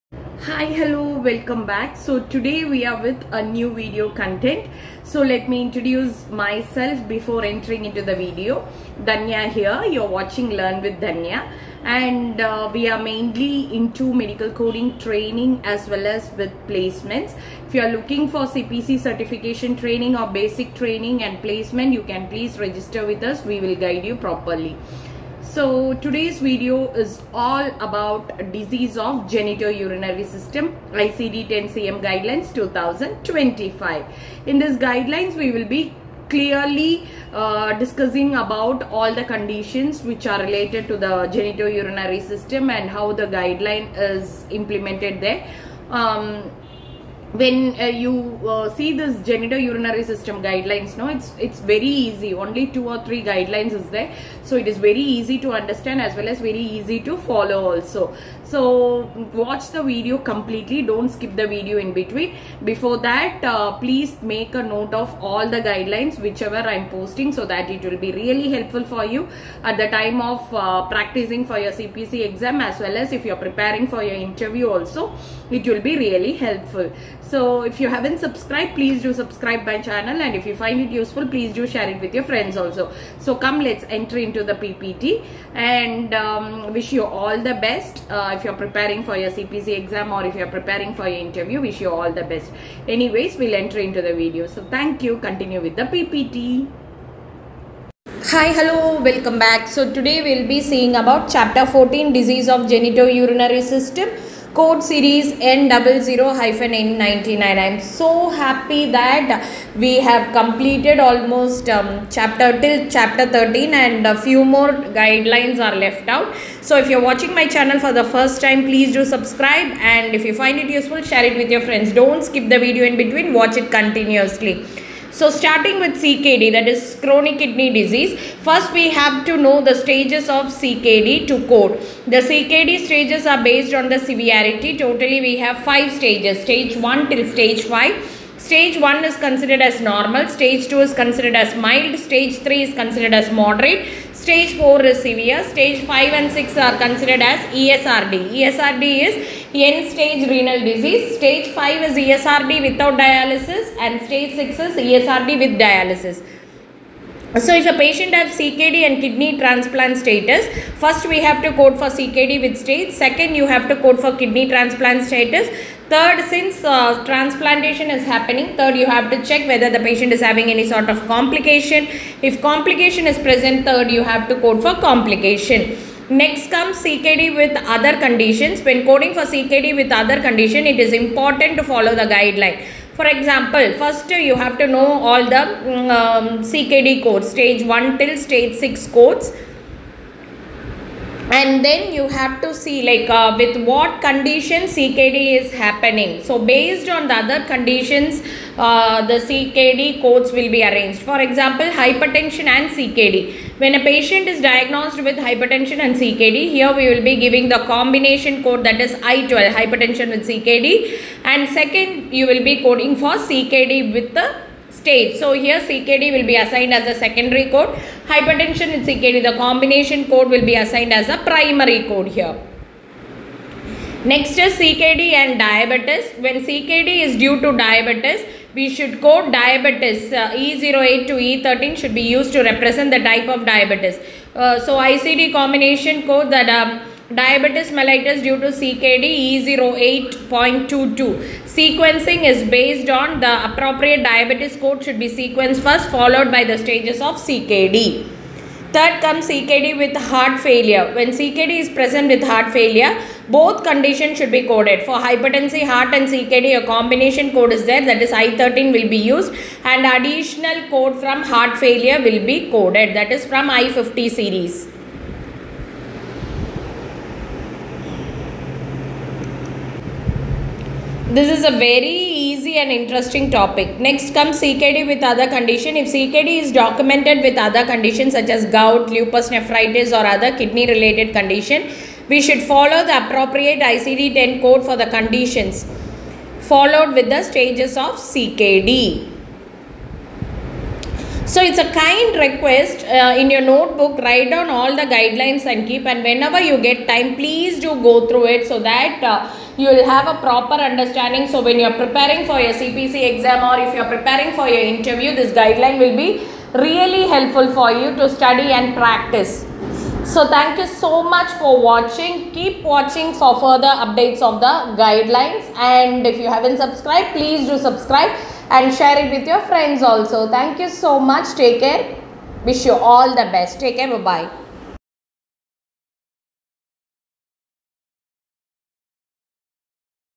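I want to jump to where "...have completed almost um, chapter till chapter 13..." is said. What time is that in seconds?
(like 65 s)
109 s.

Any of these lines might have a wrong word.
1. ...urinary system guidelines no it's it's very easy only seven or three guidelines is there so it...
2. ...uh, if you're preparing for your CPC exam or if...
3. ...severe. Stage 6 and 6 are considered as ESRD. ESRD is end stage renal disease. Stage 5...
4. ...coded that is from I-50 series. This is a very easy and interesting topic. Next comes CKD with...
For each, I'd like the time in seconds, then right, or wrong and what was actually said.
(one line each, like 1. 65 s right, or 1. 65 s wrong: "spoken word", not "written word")
1. 49 s wrong: "two", not "seven"
2. 88 s right
3. 145 s wrong: "5", not "6"
4. 262 s right.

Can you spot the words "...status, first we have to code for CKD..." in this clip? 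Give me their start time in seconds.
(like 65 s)
159 s.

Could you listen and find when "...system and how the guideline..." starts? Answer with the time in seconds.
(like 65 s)
42 s.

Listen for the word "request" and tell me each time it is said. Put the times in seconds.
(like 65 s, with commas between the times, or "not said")
292 s.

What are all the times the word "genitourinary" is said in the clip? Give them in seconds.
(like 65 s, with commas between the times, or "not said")
29 s, 41 s, 102 s.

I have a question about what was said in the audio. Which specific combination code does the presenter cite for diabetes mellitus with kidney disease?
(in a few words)
E08.22.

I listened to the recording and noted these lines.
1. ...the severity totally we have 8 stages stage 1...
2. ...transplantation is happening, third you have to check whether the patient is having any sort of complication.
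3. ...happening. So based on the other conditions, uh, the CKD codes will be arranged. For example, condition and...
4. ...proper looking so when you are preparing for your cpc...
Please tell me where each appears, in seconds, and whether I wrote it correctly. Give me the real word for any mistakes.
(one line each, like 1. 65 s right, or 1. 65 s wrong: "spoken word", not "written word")
1. 133 s wrong: "5", not "8"
2. 167 s right
3. 195 s wrong: "hypertension", not "condition"
4. 300 s wrong: "understanding", not "looking".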